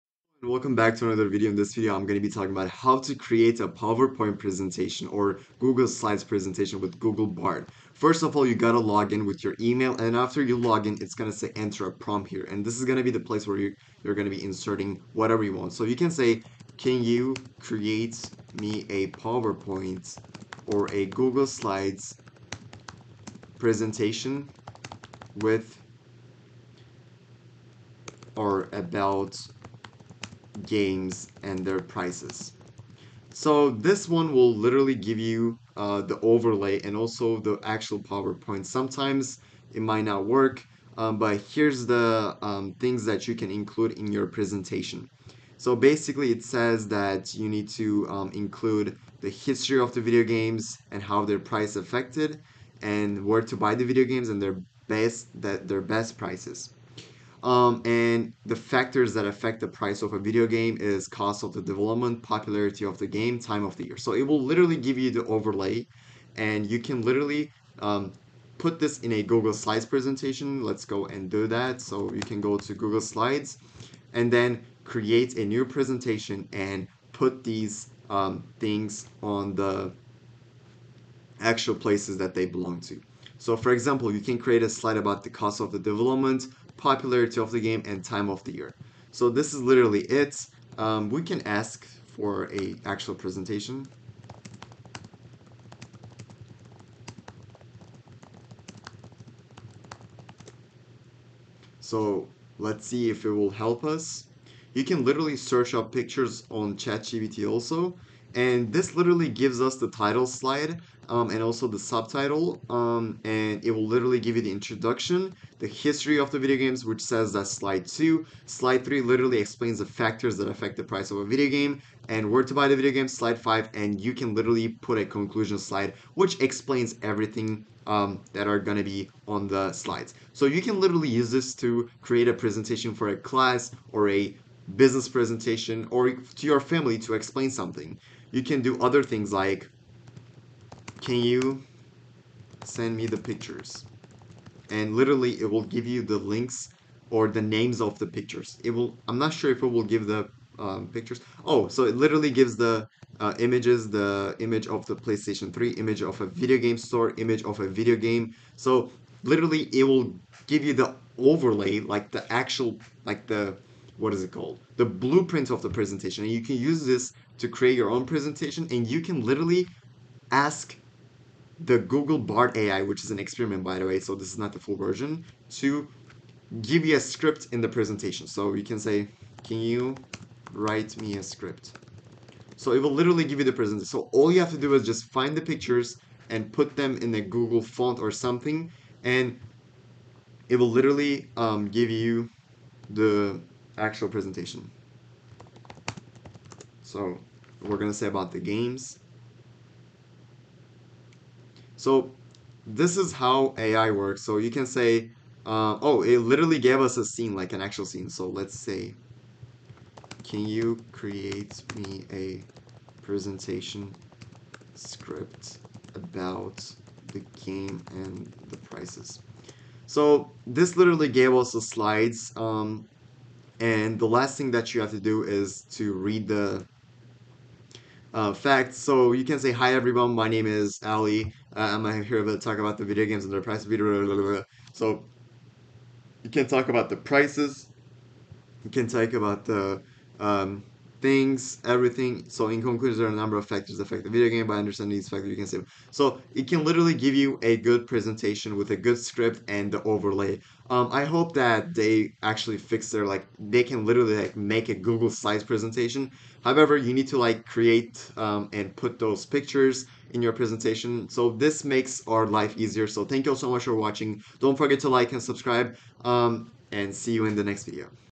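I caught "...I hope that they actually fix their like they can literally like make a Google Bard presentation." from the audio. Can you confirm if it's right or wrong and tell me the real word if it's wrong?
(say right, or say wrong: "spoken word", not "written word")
wrong: "Slides", not "Bard".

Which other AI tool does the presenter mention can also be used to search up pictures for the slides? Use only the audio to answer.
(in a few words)
ChatGPT.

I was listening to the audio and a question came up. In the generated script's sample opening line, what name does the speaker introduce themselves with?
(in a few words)
Ali.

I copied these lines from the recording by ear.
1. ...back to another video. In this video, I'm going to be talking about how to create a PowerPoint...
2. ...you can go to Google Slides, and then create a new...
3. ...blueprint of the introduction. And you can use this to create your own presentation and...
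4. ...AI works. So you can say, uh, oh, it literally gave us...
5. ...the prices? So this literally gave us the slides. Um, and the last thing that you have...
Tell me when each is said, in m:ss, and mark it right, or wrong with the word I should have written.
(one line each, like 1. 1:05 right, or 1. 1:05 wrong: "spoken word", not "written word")
1. 0:00 right
2. 1:12 right
3. 2:44 wrong: "presentation", not "introduction"
4. 3:23 right
5. 3:38 right.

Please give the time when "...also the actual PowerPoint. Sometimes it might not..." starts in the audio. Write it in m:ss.
0:36.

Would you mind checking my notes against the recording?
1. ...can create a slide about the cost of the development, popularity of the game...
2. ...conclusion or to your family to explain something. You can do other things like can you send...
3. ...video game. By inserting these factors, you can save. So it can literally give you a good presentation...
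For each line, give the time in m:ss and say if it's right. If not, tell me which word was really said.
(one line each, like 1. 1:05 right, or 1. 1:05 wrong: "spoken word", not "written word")
1. 1:24 right
2. 2:15 wrong: "presentation", not "conclusion"
3. 4:04 wrong: "understanding", not "inserting".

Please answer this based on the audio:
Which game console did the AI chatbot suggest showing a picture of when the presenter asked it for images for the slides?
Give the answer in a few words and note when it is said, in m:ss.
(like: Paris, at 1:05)
PlayStation 3, at 2:34.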